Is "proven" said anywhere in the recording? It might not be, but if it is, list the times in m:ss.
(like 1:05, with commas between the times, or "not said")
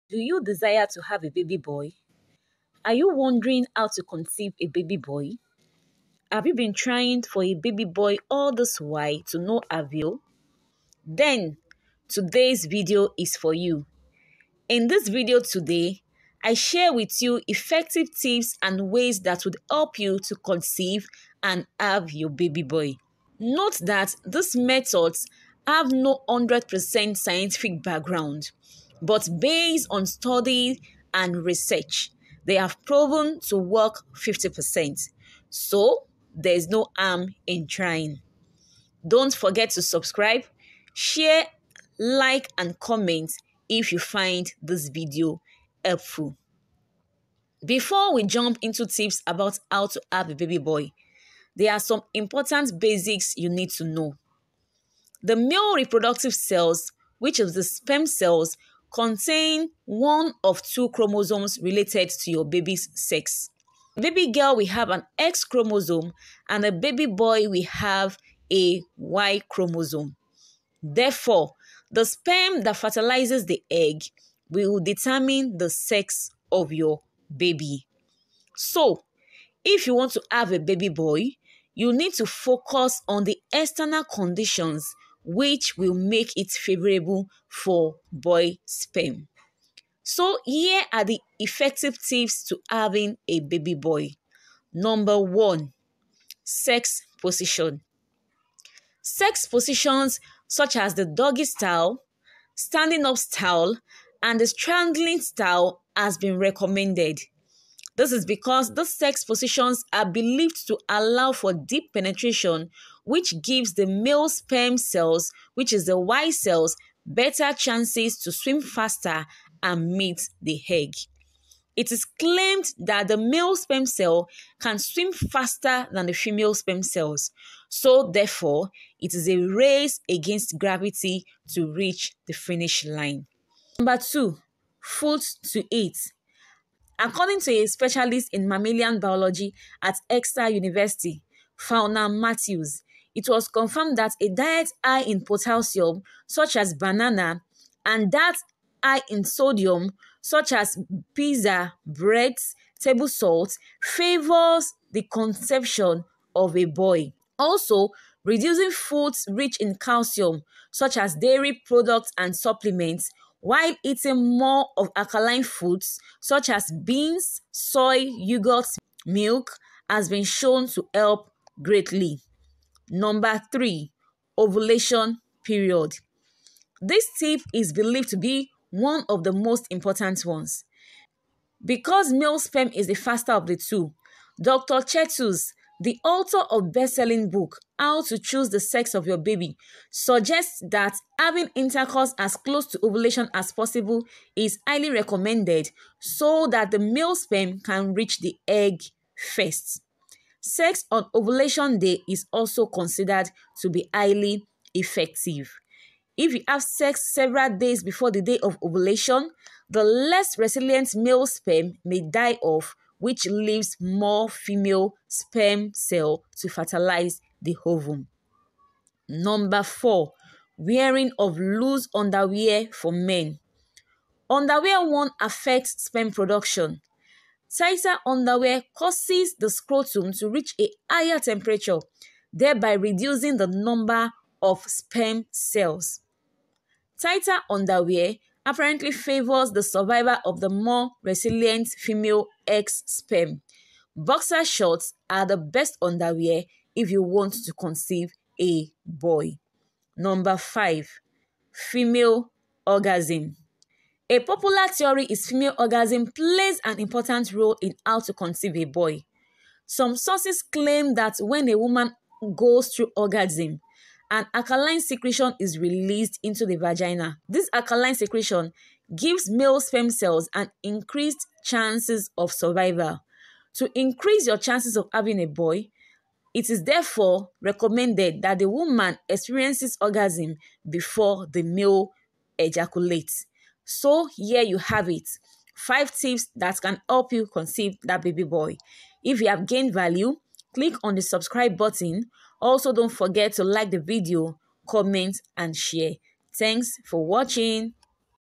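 0:32.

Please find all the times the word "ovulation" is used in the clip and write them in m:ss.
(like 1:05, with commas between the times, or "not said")
2:54, 3:12, 3:21, 3:28.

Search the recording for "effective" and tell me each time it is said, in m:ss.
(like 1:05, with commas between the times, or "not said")
0:17, 1:31, 3:24.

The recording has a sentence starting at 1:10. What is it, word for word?
Therefore, the sperm that fertilizes the egg will determine the sex of your baby.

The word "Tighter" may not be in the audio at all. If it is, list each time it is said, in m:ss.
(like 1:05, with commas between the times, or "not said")
3:47, 3:57.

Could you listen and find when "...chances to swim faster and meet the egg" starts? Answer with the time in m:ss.
1:57.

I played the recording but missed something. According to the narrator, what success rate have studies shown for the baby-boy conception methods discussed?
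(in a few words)
50%.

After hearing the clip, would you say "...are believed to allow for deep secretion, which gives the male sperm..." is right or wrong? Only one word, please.
wrong.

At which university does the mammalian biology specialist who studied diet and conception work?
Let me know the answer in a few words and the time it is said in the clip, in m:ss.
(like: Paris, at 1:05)
Exeter University, at 2:20.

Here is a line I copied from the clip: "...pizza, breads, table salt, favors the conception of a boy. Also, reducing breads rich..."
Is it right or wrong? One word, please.
wrong.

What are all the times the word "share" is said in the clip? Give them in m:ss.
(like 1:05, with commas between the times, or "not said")
0:16, 0:40, 4:55.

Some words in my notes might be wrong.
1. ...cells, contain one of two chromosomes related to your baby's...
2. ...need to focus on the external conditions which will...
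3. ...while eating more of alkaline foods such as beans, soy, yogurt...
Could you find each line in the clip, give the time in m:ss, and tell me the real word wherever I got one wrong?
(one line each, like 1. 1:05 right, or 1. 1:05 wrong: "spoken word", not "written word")
1. 0:58 right
2. 1:21 right
3. 2:43 right.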